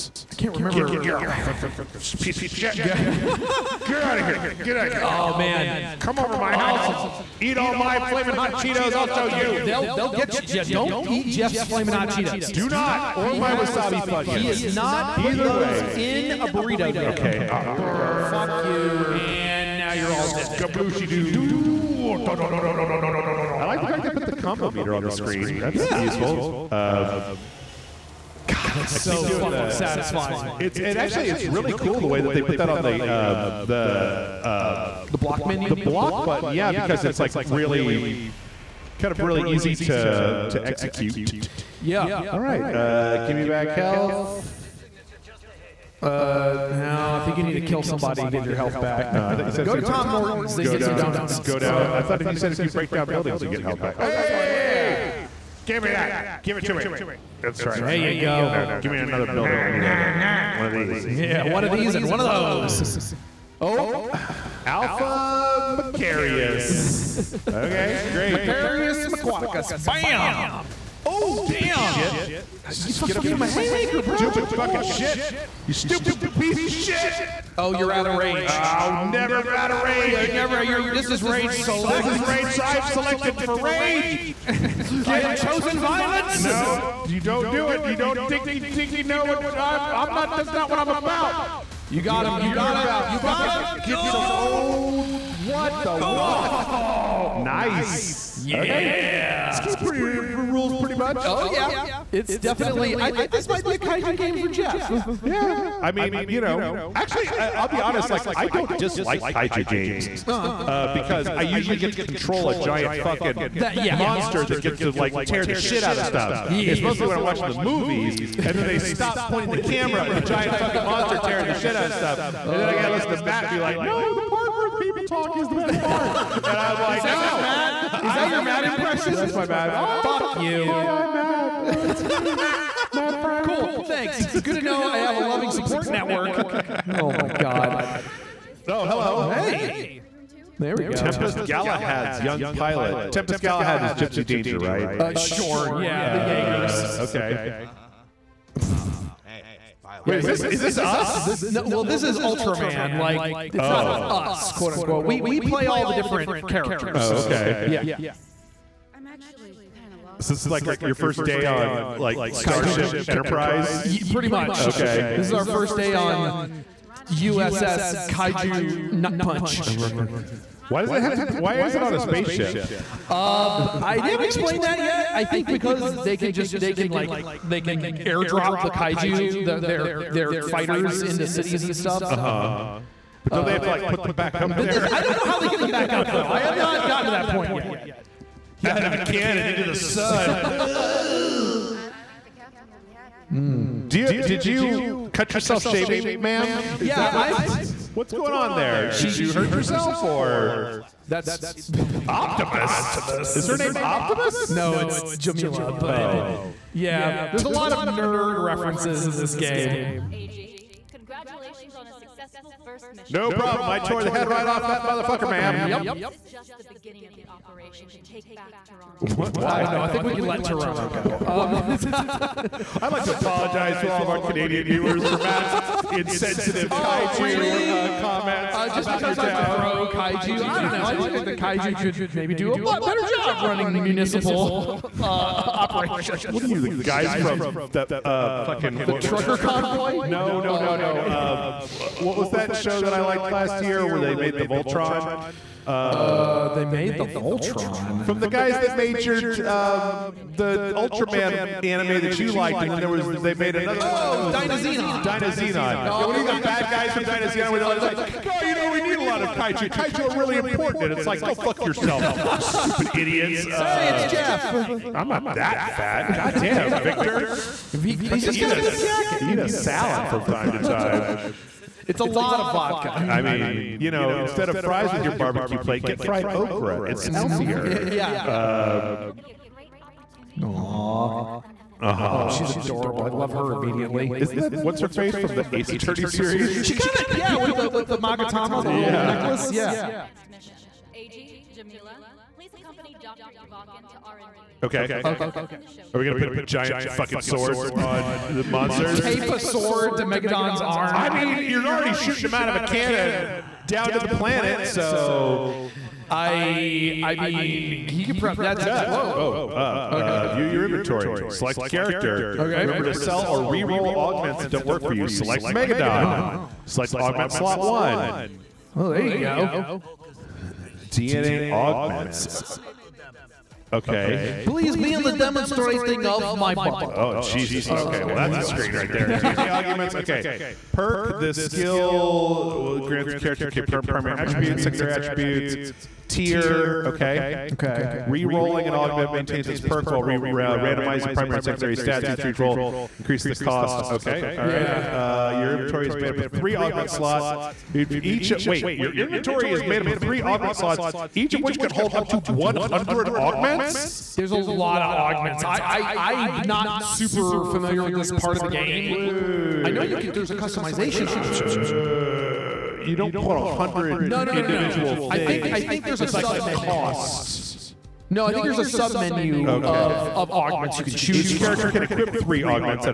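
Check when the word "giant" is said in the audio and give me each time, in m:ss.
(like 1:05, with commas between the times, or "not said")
1:52, 2:00, 4:56.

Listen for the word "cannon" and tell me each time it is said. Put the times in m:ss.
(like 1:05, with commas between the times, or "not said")
3:08, 5:02.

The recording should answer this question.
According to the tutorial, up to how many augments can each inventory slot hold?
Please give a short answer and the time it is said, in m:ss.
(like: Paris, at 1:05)
100, at 5:52.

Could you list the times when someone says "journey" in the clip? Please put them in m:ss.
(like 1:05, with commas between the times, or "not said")
not said.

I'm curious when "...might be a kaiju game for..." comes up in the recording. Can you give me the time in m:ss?
1:43.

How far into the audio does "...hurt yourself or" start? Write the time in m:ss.
3:19.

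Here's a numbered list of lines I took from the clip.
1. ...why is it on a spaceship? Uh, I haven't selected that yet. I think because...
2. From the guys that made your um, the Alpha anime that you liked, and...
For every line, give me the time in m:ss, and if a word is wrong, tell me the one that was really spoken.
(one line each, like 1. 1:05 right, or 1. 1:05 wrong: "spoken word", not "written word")
1. 2:51 wrong: "explained", not "selected"
2. 4:08 wrong: "Ultraman", not "Alpha".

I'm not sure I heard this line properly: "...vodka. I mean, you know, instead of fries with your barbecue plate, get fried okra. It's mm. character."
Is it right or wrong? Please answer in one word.
wrong.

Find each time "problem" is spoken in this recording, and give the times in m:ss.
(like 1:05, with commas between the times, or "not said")
3:33.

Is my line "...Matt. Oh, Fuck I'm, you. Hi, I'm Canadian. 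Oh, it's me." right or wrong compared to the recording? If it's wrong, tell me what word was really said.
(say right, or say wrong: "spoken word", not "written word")
wrong: "Matt", not "Canadian".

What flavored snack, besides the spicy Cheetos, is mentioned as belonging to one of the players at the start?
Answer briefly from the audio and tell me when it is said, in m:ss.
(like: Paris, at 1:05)
wasabi Funyuns, at 0:13.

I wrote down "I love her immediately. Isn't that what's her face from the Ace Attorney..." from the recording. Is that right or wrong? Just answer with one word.
right.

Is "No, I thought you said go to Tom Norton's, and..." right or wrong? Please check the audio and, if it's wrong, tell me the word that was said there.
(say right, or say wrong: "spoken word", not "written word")
right.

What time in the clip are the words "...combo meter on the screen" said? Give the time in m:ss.
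0:24.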